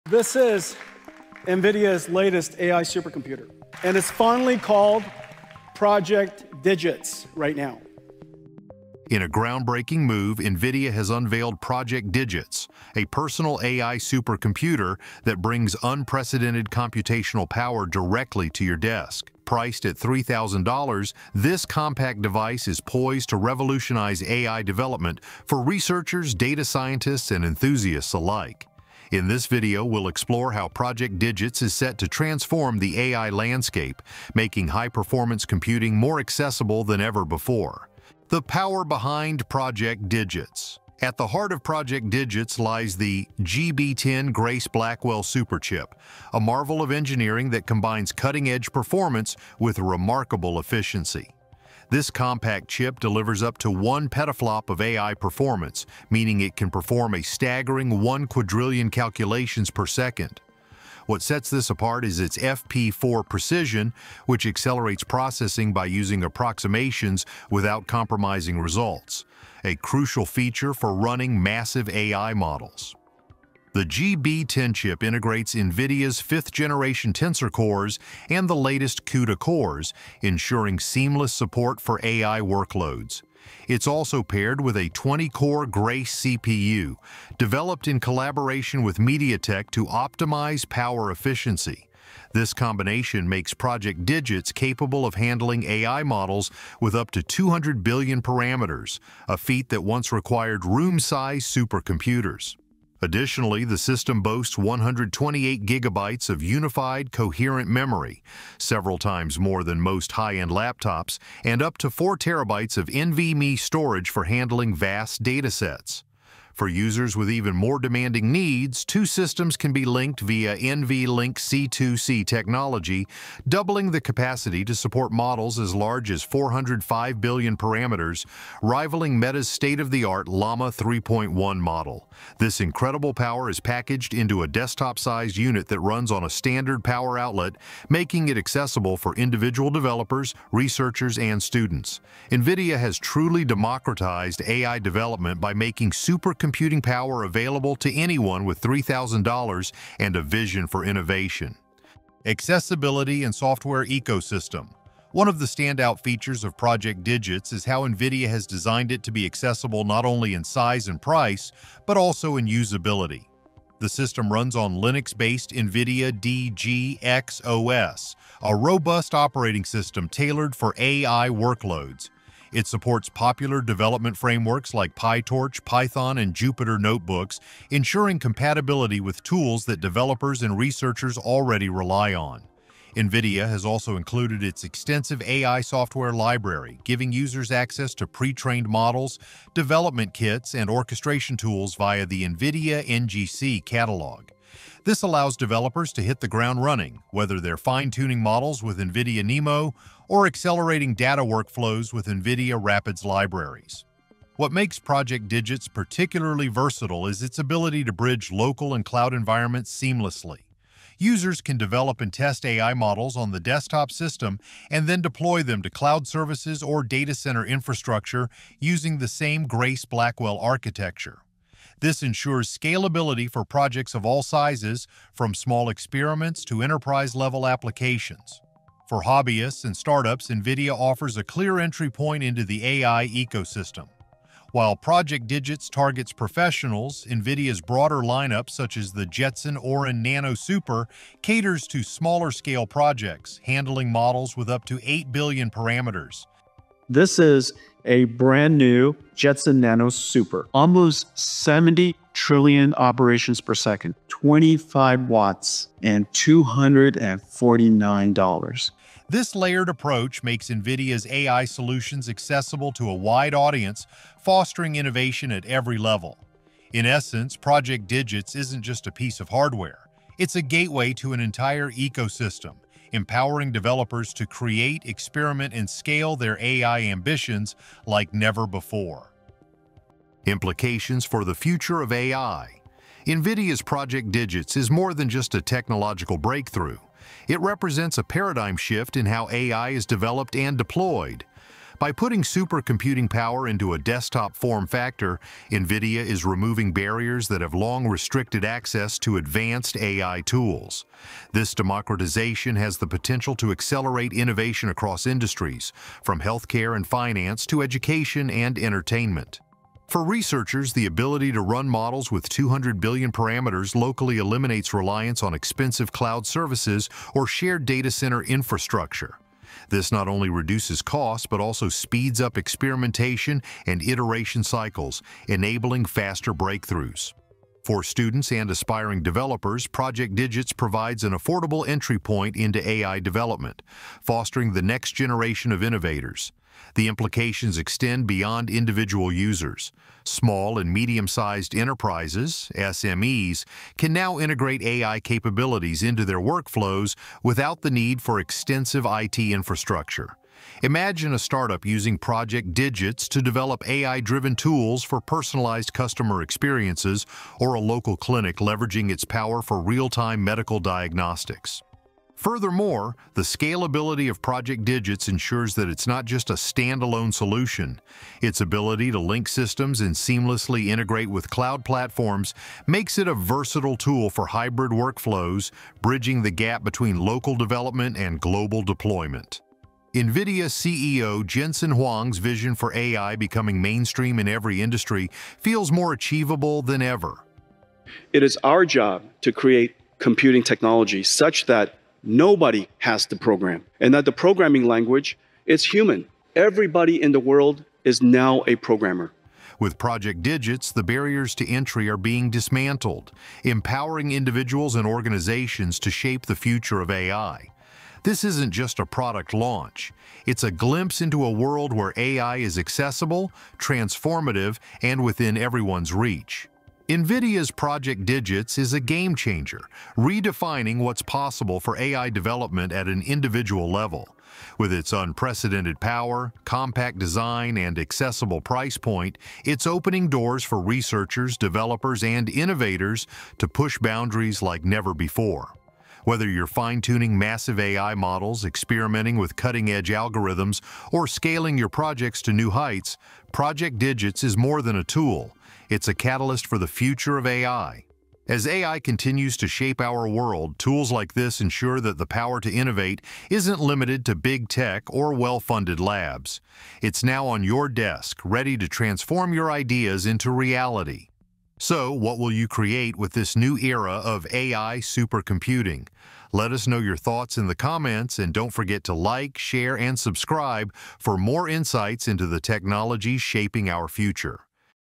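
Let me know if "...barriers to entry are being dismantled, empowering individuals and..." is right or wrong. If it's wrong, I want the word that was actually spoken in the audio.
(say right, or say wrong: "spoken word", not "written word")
right.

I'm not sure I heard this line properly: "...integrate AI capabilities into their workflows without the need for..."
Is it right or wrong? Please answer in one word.
right.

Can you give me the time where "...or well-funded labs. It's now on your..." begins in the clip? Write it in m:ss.
7:34.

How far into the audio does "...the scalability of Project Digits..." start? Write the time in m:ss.
6:03.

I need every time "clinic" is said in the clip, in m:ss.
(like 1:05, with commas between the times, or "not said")
5:57.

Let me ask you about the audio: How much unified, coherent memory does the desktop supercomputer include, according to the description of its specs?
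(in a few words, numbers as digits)
128 gigabytes.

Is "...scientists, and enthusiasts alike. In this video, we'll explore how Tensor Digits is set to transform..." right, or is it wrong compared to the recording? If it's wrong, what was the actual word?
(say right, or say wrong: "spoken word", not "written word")
wrong: "Project", not "Tensor".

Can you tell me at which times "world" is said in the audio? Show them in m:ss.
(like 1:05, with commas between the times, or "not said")
6:37, 6:51, 7:30.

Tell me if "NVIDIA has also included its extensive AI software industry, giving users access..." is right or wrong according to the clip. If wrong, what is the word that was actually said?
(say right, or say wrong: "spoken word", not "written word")
wrong: "library", not "industry".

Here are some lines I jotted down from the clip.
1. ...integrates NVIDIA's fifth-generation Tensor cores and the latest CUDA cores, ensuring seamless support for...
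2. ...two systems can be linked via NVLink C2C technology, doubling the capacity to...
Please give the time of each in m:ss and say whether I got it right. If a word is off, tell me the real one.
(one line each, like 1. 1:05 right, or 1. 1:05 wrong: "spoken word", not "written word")
1. 1:15 right
2. 1:58 right.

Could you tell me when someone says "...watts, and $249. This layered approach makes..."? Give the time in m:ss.
4:15.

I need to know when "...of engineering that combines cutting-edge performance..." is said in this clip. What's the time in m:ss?
0:46.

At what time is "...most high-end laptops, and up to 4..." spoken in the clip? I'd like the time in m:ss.
1:49.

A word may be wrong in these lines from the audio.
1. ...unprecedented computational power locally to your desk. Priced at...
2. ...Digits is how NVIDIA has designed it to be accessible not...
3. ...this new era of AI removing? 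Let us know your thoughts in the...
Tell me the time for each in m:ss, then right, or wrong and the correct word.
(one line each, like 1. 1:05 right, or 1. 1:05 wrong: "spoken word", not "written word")
1. 0:15 wrong: "directly", not "locally"
2. 2:37 right
3. 7:43 wrong: "supercomputing", not "removing".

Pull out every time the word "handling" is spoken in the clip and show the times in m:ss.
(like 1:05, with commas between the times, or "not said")
1:35, 1:54, 4:03.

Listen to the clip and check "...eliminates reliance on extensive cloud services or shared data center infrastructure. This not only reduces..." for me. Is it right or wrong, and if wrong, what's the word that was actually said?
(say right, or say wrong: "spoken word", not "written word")
wrong: "expensive", not "extensive".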